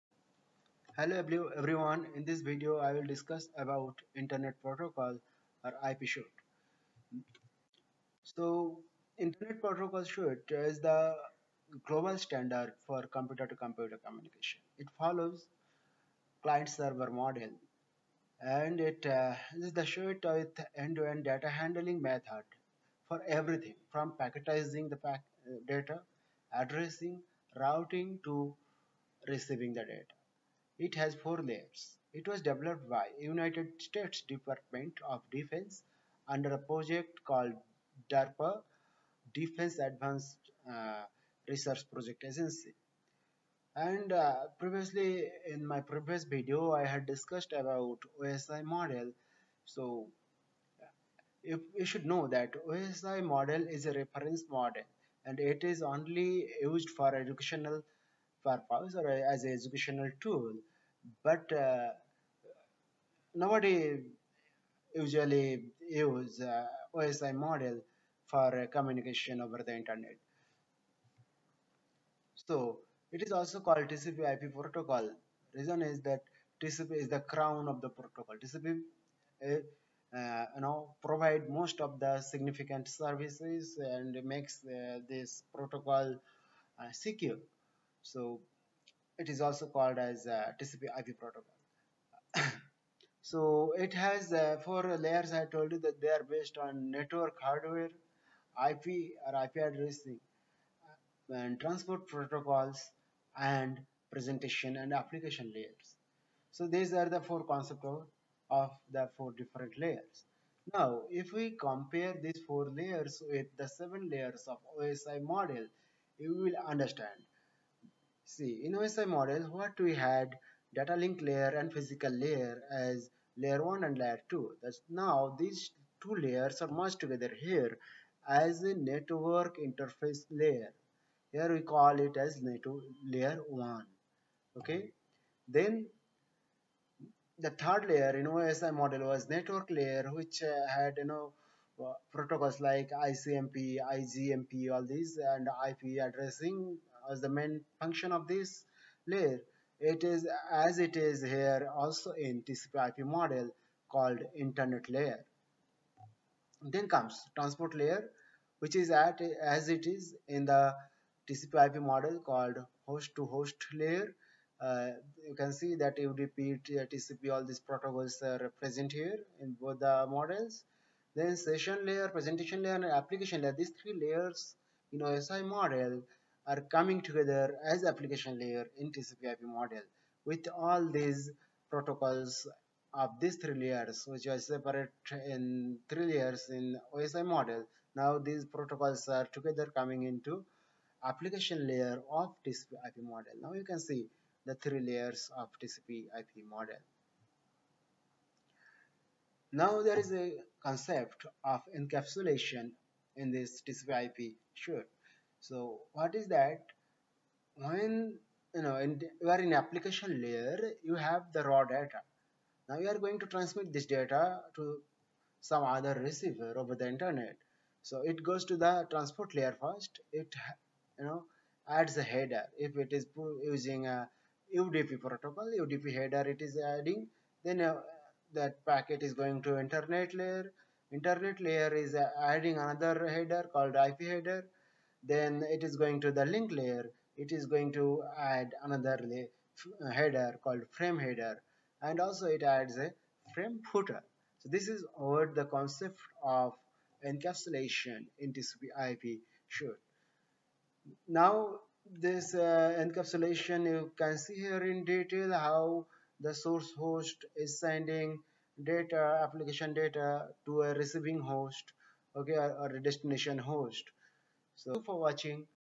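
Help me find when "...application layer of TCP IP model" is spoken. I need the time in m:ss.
3:11.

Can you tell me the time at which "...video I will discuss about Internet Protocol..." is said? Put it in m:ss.
0:02.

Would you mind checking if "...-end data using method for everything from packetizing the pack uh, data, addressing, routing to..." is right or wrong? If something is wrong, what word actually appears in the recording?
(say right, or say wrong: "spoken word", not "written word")
wrong: "handling", not "using".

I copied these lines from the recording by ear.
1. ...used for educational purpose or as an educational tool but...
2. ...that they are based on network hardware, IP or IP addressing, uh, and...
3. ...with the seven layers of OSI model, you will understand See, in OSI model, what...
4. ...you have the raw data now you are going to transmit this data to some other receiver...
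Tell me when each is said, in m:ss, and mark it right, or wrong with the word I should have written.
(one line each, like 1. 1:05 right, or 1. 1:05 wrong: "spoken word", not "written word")
1. 0:56 right
2. 1:35 right
3. 1:53 right
4. 3:30 right.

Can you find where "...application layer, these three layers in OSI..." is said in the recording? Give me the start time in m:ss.
2:52.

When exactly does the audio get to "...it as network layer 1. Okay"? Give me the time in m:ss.
2:11.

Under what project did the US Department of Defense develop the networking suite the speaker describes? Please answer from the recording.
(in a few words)
DARPA.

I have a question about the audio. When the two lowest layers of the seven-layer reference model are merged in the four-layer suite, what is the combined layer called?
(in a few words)
network interface layer.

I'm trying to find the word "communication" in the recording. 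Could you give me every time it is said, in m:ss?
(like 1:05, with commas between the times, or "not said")
0:14, 1:08.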